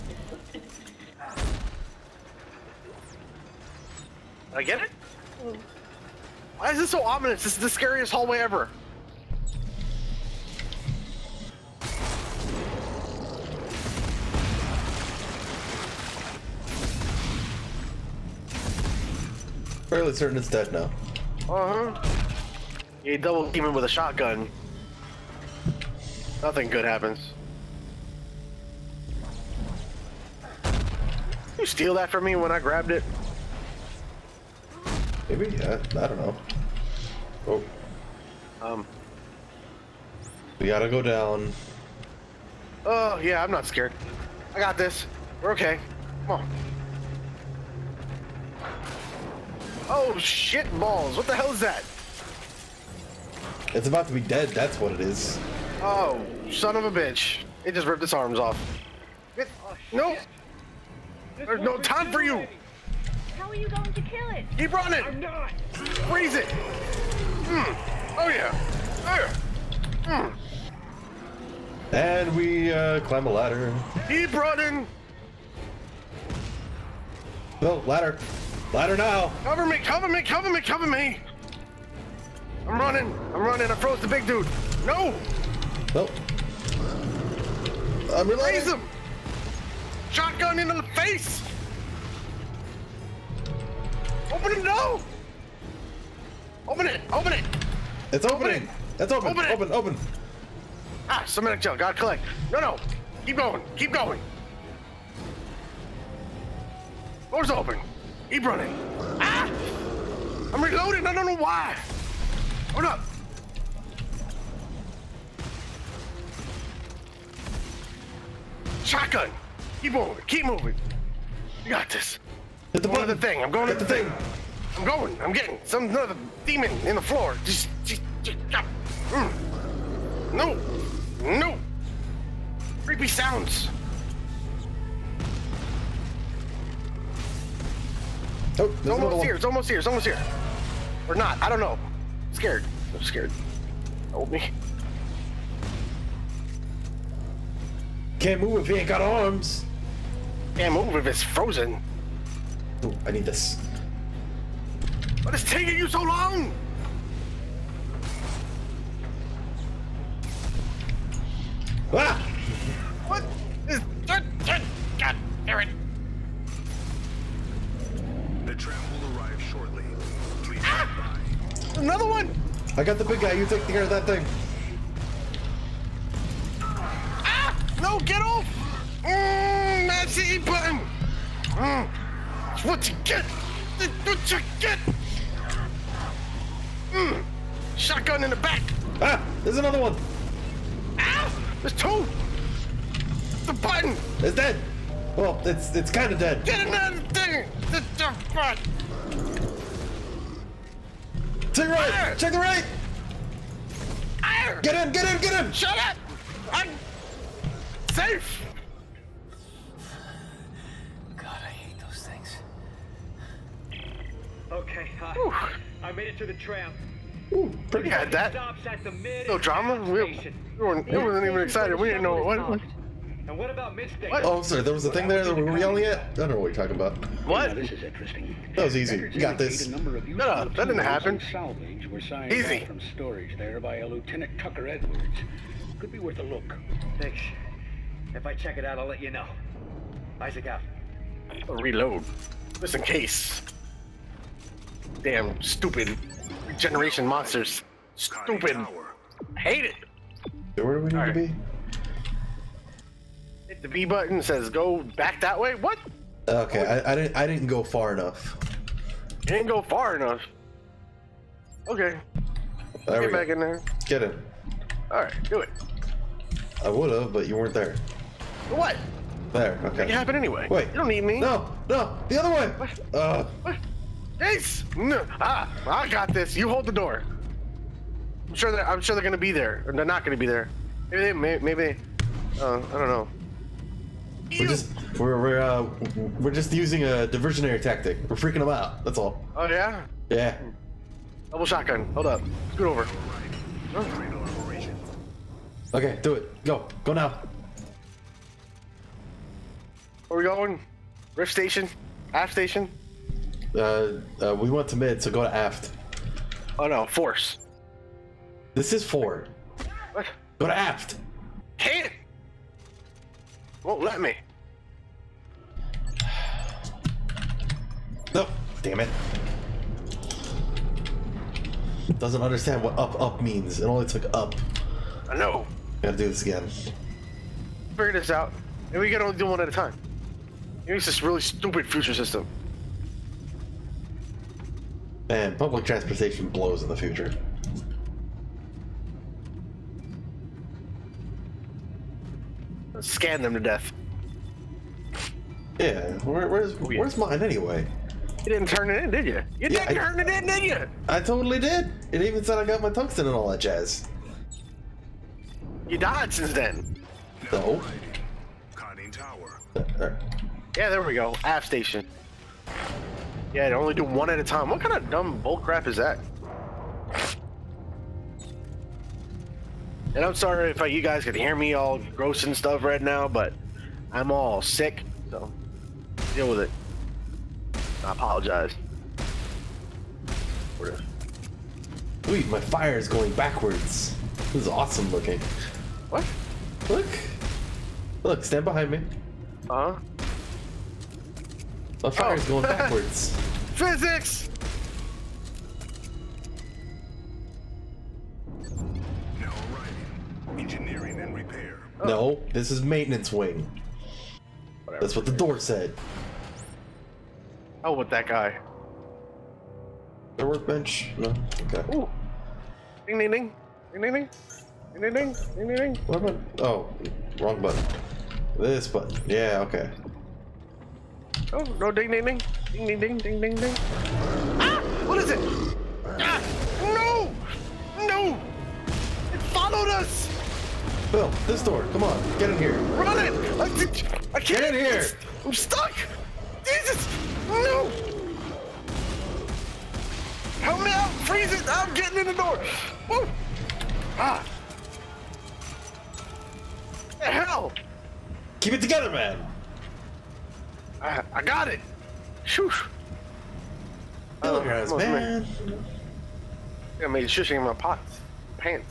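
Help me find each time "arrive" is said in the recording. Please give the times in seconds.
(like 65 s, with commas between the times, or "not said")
169 s.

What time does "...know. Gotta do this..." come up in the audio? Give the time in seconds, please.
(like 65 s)
325 s.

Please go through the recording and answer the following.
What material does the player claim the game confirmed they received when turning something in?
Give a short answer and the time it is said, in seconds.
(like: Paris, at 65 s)
Tungsten, at 352 s.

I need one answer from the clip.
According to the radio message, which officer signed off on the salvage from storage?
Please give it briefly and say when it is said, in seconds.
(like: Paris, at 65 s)
Lieutenant Tucker Edwards, at 233 s.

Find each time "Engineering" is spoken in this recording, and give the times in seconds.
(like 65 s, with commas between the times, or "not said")
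400 s.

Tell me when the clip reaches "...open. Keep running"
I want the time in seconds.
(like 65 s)
107 s.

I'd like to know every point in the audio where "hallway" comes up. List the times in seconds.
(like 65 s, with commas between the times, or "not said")
8 s.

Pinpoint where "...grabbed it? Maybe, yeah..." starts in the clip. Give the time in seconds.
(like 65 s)
32 s.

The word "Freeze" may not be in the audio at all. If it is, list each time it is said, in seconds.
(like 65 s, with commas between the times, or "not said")
65 s, 441 s.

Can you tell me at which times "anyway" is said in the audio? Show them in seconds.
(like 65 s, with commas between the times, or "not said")
270 s, 347 s.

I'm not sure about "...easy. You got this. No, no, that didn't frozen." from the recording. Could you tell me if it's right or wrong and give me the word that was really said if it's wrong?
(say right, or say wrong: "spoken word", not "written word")
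wrong: "happen", not "frozen".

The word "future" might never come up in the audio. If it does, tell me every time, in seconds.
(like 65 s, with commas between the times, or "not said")
331 s, 336 s.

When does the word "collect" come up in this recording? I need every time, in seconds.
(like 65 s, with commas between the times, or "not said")
101 s.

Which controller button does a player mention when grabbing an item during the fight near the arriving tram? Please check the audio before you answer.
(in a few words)
E button.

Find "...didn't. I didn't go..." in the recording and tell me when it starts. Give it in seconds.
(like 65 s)
256 s.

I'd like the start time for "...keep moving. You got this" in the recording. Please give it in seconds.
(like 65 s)
120 s.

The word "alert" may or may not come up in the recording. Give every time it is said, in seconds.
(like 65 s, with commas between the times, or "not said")
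not said.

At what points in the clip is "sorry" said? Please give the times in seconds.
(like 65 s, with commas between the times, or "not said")
224 s, 370 s.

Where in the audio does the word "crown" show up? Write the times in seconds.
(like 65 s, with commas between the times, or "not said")
not said.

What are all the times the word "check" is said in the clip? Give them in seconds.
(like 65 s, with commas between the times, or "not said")
202 s, 238 s.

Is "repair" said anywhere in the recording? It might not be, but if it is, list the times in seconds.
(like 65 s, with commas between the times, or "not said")
401 s.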